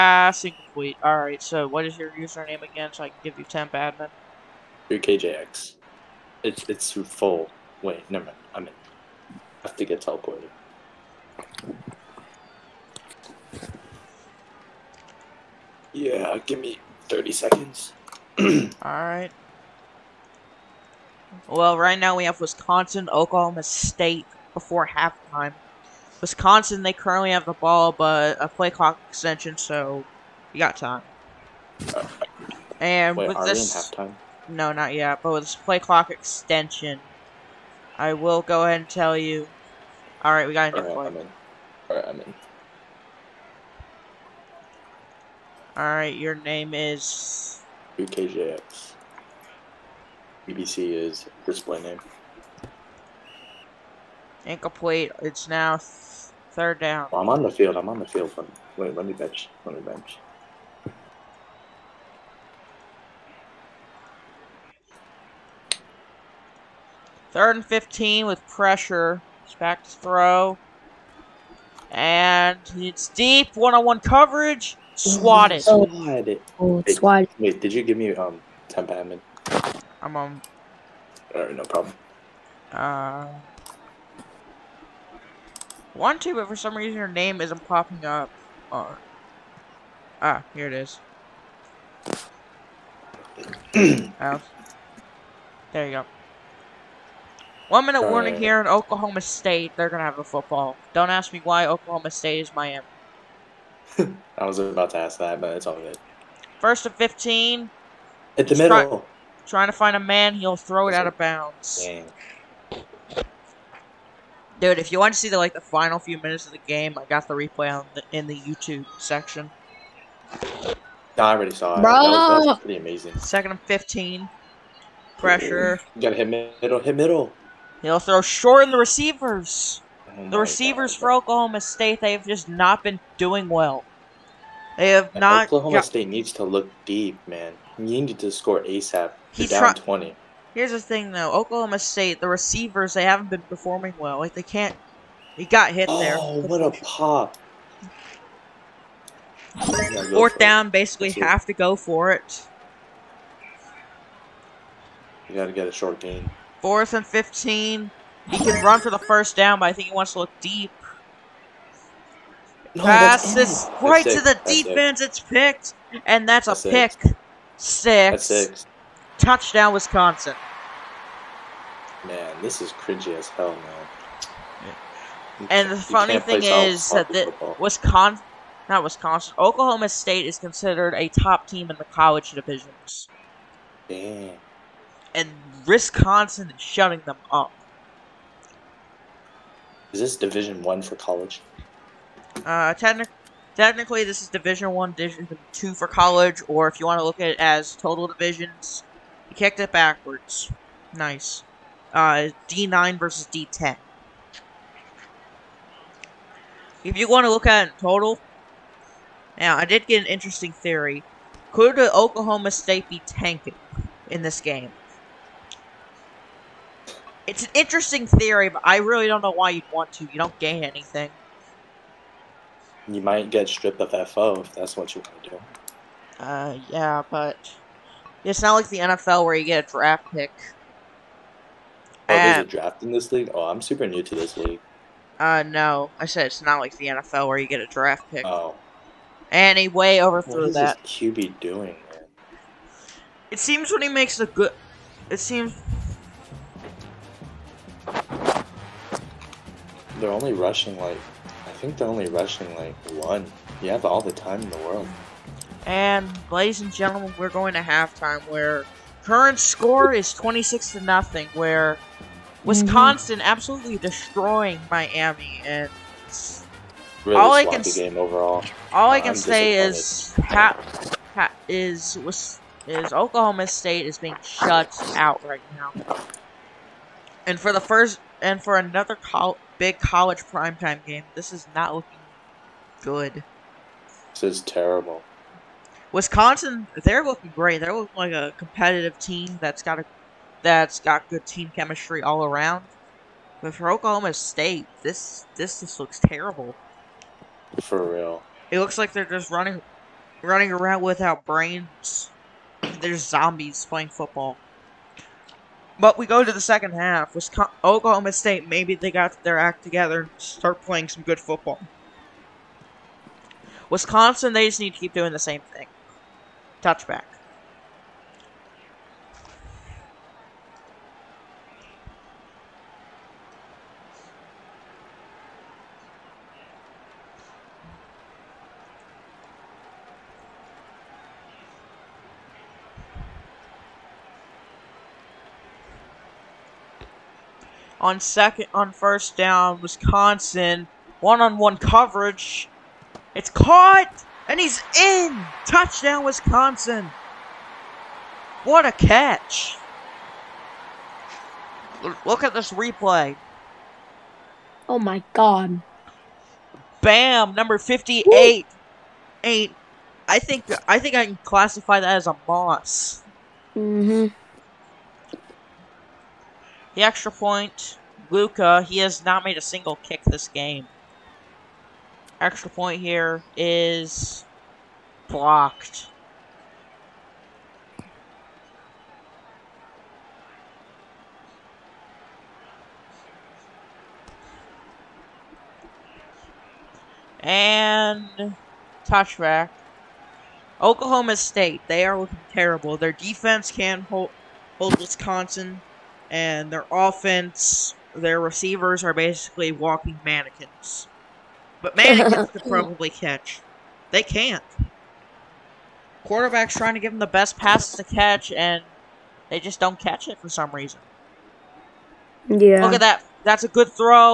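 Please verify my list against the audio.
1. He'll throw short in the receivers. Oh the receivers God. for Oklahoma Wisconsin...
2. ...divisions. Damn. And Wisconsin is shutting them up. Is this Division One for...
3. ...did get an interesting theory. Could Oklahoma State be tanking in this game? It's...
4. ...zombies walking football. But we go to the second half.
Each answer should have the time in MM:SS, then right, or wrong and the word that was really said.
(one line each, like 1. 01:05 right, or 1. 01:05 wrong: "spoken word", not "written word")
1. 02:07 wrong: "State", not "Wisconsin"
2. 03:02 right
3. 03:29 right
4. 05:02 wrong: "playing", not "walking".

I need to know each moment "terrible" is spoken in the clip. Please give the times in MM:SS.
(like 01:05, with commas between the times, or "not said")
04:44, 04:55, 06:32.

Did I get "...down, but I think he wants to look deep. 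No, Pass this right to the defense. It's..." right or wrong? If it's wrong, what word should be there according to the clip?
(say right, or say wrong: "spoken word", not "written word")
right.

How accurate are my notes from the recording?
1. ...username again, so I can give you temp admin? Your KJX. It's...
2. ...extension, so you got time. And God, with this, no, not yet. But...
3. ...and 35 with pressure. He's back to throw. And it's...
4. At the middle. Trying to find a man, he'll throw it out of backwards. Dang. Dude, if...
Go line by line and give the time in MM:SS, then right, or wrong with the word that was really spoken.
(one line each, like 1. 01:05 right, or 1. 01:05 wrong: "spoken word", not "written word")
1. 00:02 right
2. 00:29 wrong: "Wait", not "God"
3. 01:07 wrong: "15", not "35"
4. 01:48 wrong: "bounds", not "backwards".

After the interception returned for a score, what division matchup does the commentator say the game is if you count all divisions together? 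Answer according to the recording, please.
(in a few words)
D9 versus D10.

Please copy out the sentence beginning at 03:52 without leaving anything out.
Oh, and, there's a draft in this league?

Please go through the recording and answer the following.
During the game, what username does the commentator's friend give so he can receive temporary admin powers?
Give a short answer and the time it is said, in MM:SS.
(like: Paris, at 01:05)
UKJX, at 00:47.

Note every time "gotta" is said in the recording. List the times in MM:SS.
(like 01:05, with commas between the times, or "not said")
02:06, 02:35.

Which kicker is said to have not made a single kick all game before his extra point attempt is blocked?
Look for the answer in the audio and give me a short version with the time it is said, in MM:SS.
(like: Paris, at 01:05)
Luca, at 06:08.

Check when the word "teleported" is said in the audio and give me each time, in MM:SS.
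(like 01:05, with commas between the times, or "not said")
00:10.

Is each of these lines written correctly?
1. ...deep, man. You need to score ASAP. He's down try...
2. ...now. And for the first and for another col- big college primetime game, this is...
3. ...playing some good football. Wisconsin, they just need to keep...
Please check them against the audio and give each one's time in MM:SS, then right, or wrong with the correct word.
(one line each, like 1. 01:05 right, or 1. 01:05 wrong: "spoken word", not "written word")
1. 02:16 right
2. 04:35 right
3. 05:10 right.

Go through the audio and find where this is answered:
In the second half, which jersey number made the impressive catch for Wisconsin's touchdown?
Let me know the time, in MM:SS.
05:57.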